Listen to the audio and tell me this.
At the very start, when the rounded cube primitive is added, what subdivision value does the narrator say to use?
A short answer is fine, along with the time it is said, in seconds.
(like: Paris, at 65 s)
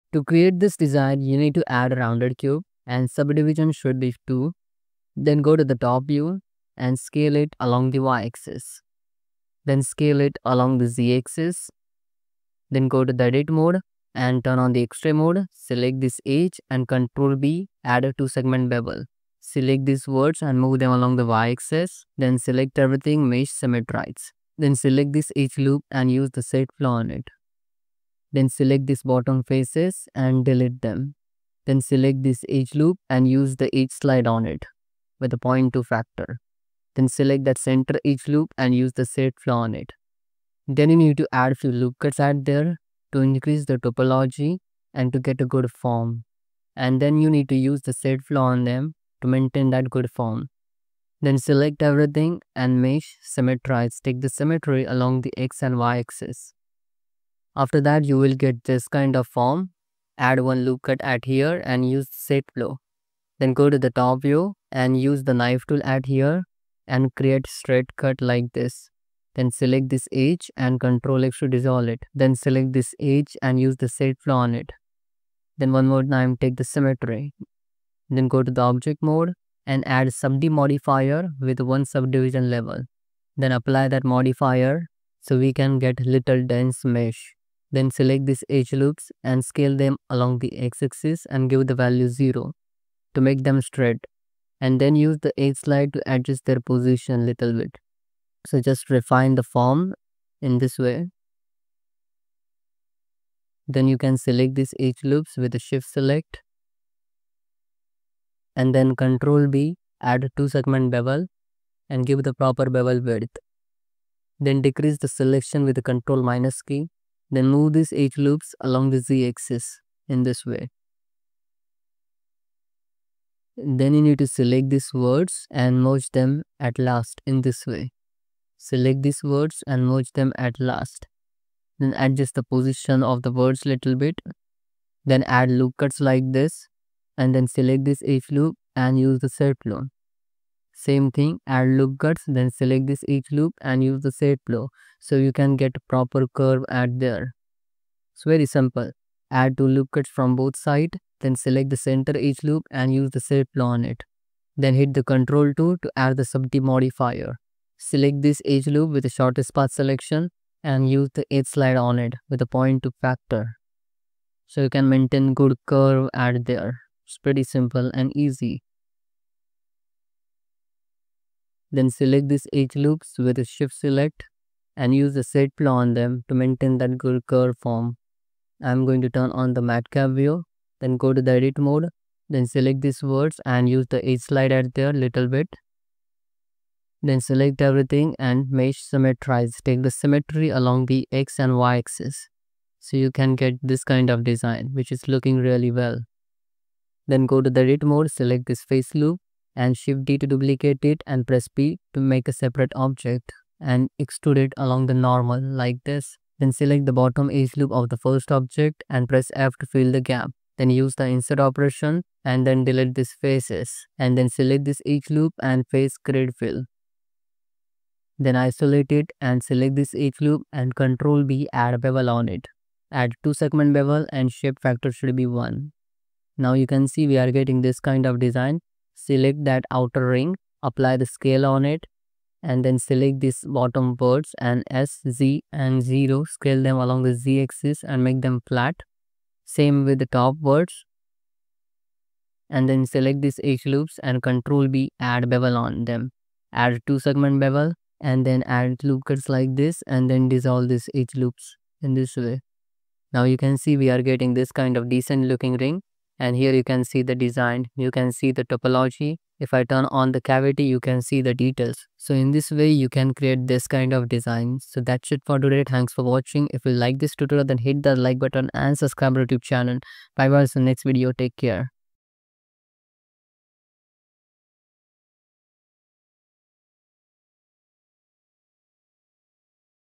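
2, at 3 s.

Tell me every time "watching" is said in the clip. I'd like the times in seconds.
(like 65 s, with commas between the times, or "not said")
266 s.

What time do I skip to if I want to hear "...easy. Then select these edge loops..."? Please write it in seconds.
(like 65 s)
168 s.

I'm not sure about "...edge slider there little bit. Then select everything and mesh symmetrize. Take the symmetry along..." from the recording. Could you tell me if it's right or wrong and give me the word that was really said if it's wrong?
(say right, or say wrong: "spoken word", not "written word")
right.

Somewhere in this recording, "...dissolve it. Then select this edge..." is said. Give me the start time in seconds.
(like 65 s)
71 s.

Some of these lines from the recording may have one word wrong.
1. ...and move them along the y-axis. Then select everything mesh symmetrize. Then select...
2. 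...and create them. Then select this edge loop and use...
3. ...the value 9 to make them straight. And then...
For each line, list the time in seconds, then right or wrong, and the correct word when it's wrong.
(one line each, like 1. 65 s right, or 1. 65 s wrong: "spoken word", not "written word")
1. 20 s right
2. 30 s wrong: "delete", not "create"
3. 91 s wrong: "0", not "9".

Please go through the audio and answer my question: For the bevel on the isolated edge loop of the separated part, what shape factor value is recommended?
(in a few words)
1.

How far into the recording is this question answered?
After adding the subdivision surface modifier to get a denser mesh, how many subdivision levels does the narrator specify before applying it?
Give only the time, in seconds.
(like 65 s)
81 s.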